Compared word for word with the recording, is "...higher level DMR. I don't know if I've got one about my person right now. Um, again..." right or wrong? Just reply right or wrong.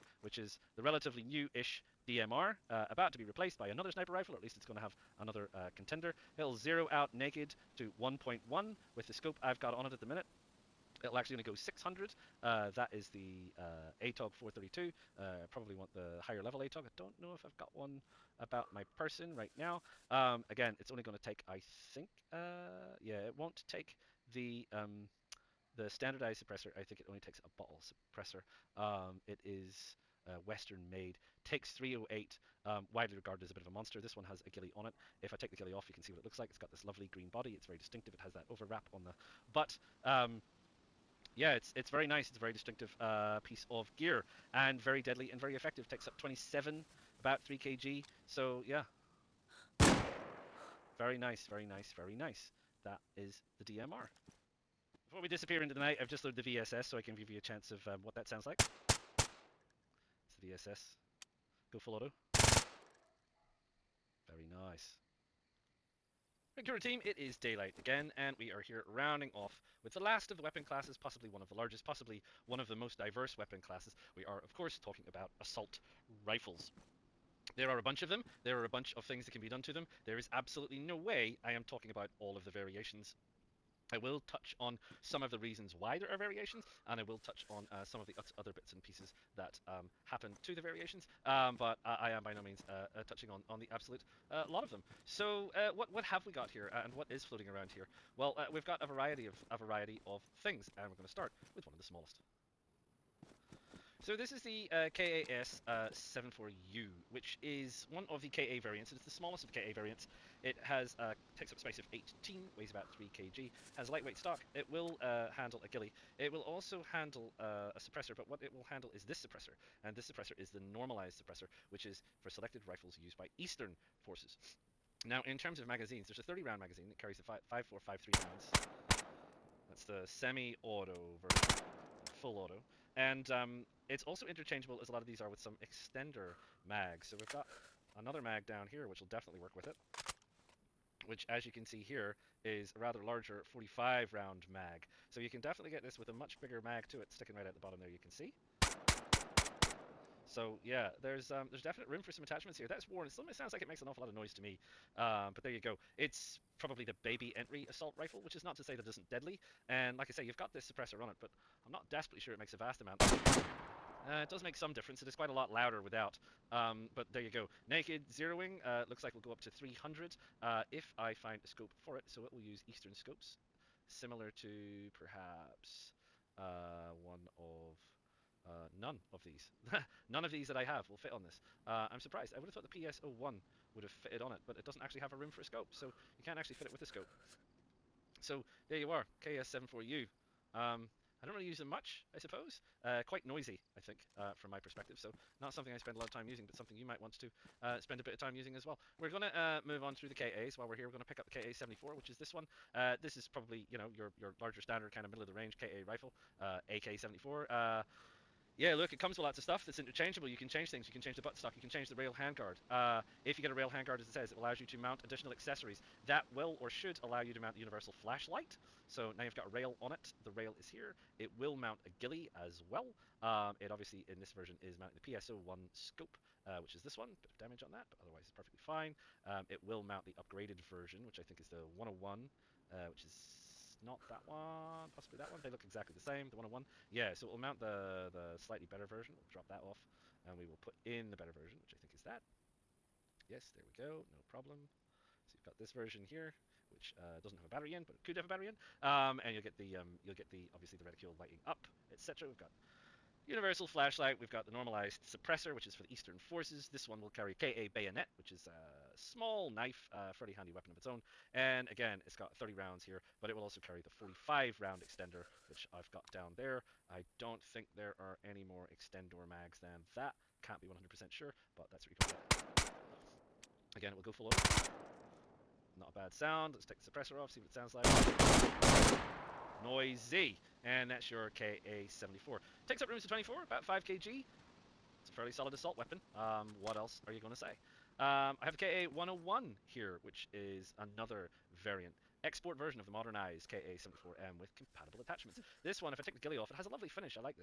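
wrong.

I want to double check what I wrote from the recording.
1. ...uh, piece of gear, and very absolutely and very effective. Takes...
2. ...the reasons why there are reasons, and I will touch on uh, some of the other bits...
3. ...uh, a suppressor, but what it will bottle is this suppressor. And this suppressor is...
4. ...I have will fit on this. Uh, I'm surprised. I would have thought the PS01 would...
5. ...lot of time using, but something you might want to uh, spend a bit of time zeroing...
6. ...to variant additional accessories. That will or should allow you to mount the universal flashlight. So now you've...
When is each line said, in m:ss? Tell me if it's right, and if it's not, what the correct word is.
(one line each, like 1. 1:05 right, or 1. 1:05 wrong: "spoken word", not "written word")
1. 0:42 wrong: "deadly", not "absolutely"
2. 1:25 wrong: "variations", not "reasons"
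3. 1:57 wrong: "handle", not "bottle"
4. 3:00 right
5. 3:15 wrong: "using", not "zeroing"
6. 3:34 wrong: "mount", not "variant".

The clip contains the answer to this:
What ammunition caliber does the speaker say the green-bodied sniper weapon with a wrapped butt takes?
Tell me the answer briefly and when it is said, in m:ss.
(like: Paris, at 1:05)
308, at 0:31.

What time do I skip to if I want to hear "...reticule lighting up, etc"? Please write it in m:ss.
4:10.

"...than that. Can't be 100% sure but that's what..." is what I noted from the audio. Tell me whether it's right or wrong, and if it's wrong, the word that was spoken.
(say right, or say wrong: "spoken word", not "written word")
right.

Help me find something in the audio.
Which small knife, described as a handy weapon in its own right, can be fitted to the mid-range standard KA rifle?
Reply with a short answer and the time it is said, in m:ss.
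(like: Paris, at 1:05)
KA bayonet, at 4:17.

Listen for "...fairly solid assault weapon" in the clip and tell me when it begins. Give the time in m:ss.
4:45.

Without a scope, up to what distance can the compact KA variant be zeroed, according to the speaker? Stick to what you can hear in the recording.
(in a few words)
300.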